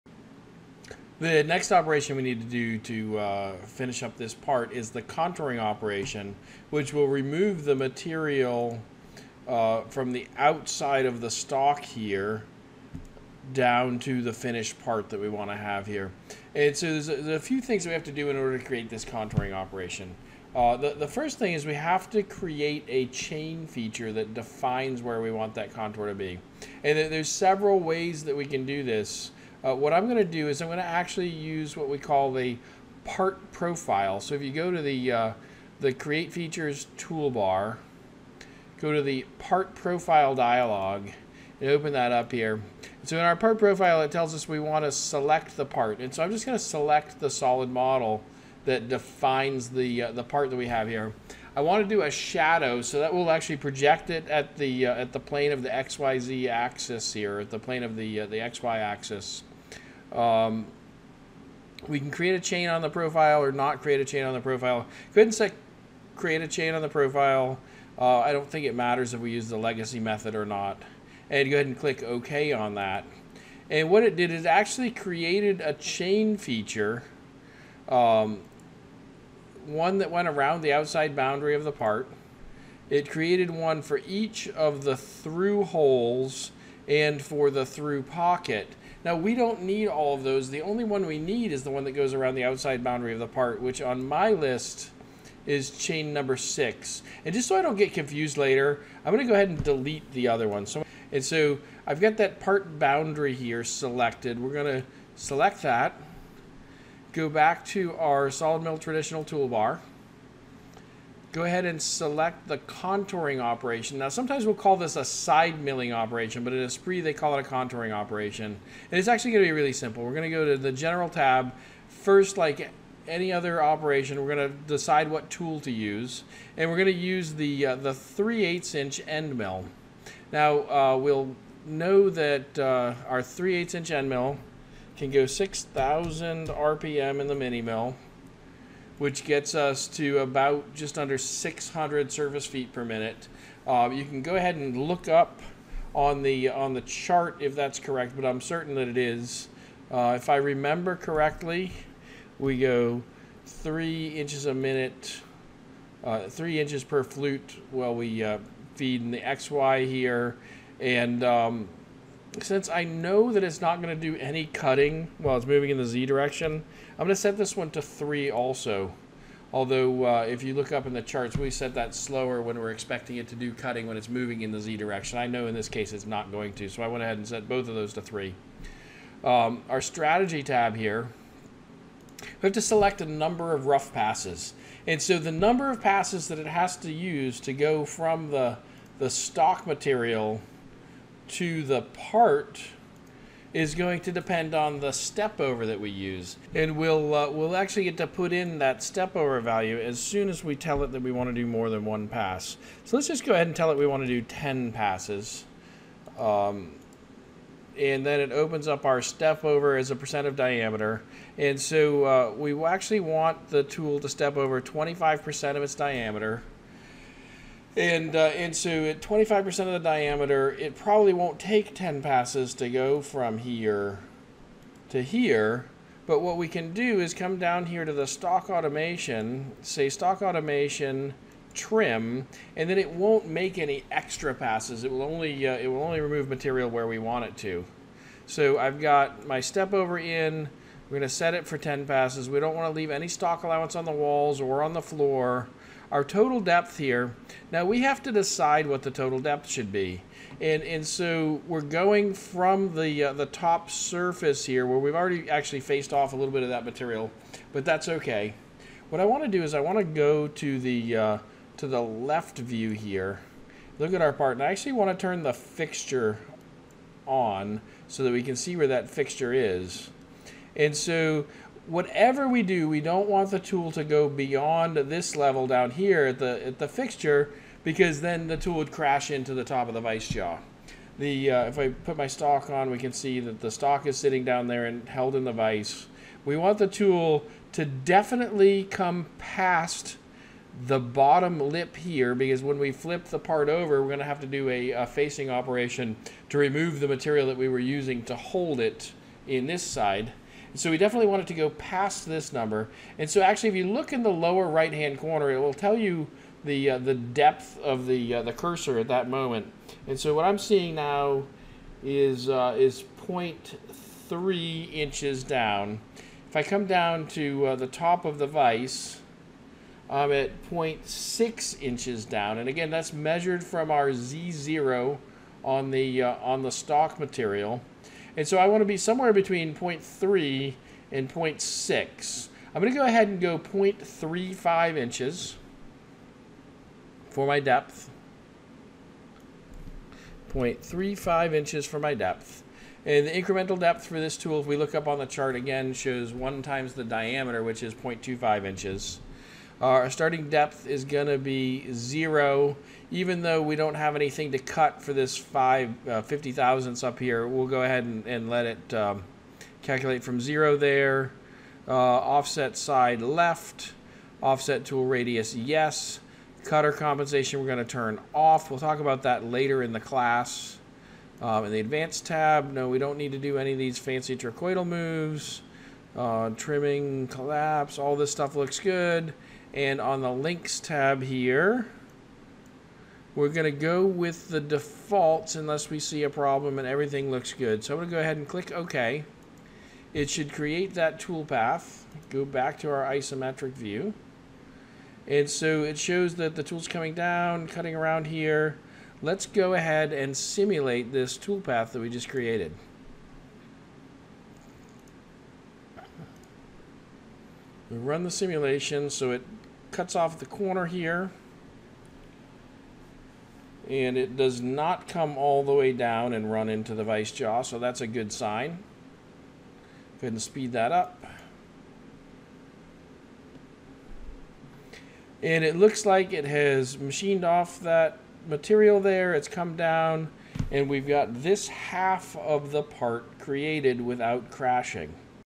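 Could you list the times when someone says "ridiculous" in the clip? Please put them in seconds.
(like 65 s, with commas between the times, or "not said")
not said.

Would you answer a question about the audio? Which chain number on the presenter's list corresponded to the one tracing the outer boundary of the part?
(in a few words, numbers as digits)
6.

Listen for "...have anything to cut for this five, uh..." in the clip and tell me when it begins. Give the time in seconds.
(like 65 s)
353 s.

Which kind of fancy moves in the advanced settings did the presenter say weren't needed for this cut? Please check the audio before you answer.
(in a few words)
trochoidal moves.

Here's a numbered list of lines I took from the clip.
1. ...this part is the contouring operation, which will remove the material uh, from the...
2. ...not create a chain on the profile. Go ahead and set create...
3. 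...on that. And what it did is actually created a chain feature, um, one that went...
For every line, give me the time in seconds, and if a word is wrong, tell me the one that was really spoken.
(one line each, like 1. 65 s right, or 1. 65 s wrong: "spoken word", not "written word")
1. 4 s right
2. 63 s right
3. 72 s right.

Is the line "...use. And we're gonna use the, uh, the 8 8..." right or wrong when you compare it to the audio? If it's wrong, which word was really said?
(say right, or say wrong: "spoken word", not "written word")
wrong: "3", not "8".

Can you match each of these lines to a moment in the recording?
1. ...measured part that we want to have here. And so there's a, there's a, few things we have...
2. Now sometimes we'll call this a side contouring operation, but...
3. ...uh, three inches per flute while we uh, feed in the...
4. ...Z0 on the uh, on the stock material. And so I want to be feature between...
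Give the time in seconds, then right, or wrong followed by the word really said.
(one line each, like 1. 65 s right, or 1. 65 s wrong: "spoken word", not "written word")
1. 14 s wrong: "finished", not "measured"
2. 113 s wrong: "milling", not "contouring"
3. 156 s right
4. 323 s wrong: "somewhere", not "feature".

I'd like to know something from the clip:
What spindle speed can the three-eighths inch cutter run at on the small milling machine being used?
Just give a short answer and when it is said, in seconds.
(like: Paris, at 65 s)
6,000 RPM, at 135 s.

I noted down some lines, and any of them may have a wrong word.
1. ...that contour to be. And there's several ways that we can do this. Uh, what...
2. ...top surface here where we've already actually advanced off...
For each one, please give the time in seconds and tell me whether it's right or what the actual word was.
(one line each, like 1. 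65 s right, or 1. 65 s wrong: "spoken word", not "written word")
1. 25 s right
2. 253 s wrong: "faced", not "advanced".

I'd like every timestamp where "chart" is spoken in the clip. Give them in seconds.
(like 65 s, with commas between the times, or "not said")
146 s, 171 s, 345 s.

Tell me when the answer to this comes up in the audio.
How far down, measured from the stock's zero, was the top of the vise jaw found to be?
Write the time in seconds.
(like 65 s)
320 s.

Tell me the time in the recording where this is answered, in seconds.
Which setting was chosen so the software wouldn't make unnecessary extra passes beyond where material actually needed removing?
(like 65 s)
229 s.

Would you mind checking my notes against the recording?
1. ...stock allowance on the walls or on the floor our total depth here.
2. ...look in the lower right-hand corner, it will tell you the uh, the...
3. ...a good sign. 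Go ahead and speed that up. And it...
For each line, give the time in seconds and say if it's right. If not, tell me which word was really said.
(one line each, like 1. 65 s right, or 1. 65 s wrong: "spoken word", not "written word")
1. 243 s right
2. 303 s right
3. 417 s right.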